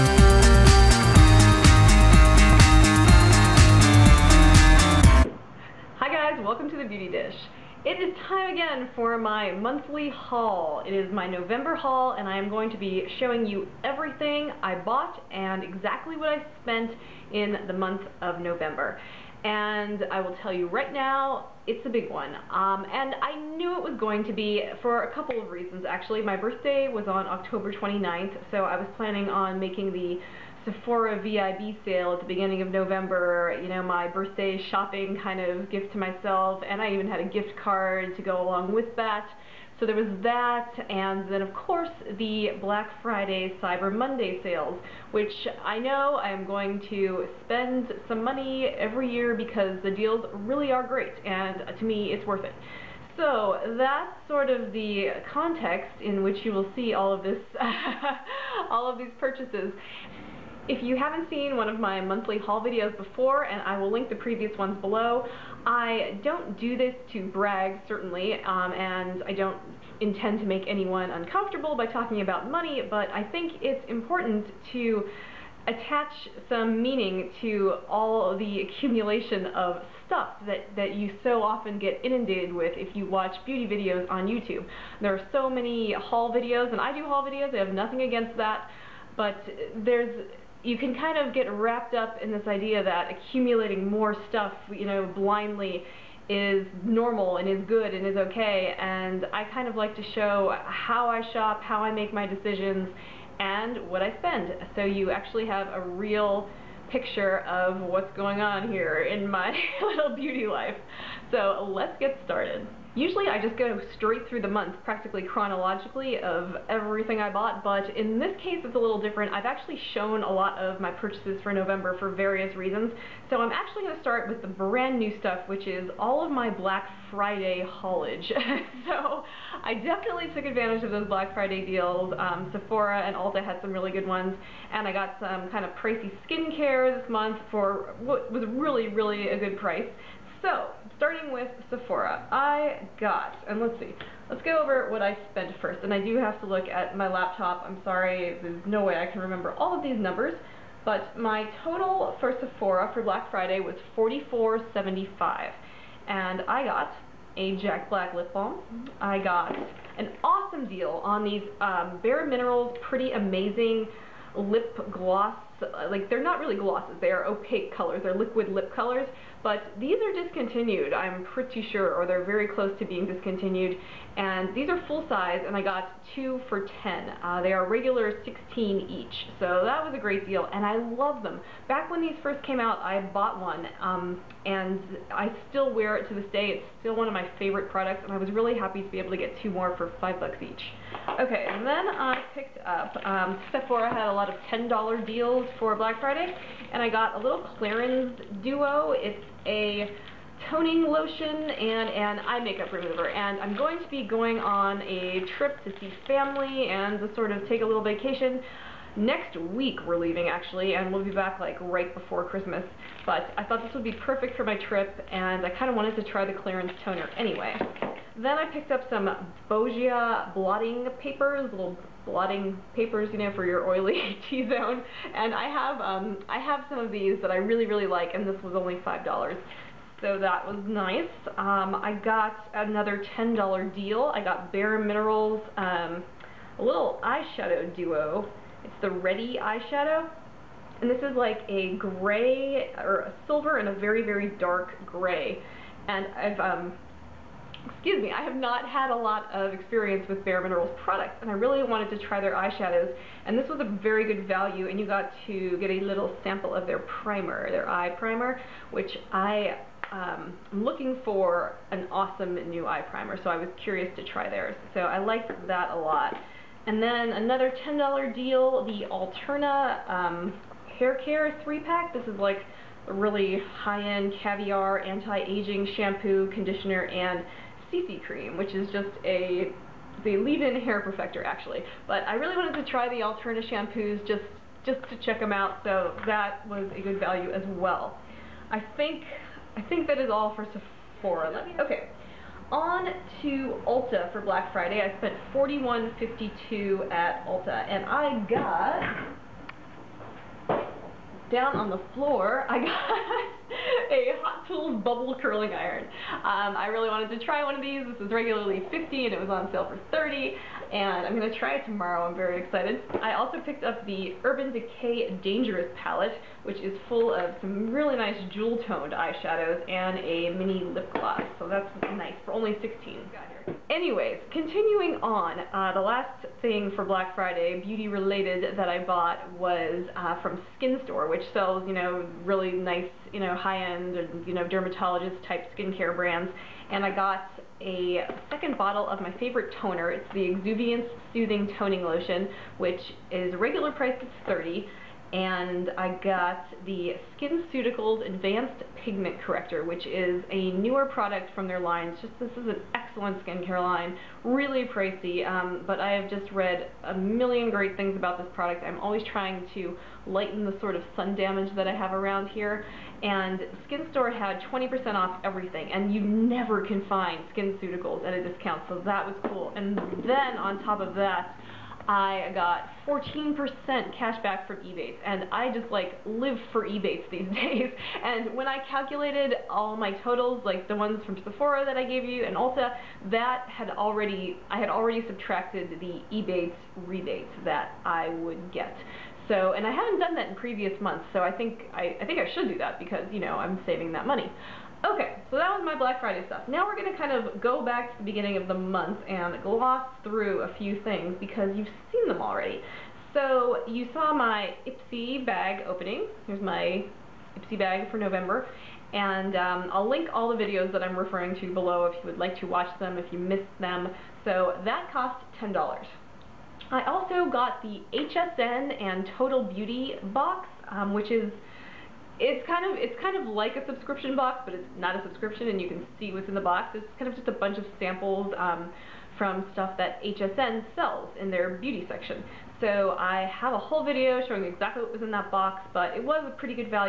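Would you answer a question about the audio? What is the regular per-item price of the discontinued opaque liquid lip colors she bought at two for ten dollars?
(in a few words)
16.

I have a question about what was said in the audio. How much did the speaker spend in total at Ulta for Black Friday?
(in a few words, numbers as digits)
$41.52.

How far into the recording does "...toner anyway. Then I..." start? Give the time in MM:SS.
03:36.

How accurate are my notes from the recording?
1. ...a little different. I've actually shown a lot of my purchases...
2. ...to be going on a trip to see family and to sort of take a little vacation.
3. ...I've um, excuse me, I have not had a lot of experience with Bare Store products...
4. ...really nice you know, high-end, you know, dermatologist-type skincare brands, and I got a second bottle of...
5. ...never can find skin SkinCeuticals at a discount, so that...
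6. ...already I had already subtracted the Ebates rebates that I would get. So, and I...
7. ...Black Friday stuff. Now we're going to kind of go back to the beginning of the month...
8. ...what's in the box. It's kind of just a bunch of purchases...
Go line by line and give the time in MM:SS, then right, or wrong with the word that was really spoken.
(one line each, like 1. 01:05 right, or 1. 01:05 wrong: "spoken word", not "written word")
1. 01:58 right
2. 03:23 right
3. 04:06 wrong: "Minerals", not "Store"
4. 05:32 right
5. 06:06 right
6. 06:23 right
7. 06:35 right
8. 07:06 wrong: "samples", not "purchases".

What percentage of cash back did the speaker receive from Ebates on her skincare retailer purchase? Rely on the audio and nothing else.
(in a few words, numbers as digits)
14%.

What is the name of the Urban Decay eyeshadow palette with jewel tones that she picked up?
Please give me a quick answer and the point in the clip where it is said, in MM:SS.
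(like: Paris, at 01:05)
Dangerous, at 05:15.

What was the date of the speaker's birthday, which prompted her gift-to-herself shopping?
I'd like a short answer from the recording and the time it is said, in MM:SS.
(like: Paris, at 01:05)
October 29th, at 00:27.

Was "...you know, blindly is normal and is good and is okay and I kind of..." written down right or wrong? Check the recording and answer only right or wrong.
right.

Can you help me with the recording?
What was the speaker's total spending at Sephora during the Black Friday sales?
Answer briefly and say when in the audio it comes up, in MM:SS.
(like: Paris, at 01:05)
$44.75, at 02:33.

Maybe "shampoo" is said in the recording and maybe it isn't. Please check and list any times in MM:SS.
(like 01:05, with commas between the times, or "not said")
04:35, 04:43.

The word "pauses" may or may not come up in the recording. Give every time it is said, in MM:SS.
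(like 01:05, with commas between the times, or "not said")
not said.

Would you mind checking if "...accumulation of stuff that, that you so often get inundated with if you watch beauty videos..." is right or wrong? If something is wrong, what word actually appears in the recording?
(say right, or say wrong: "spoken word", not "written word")
right.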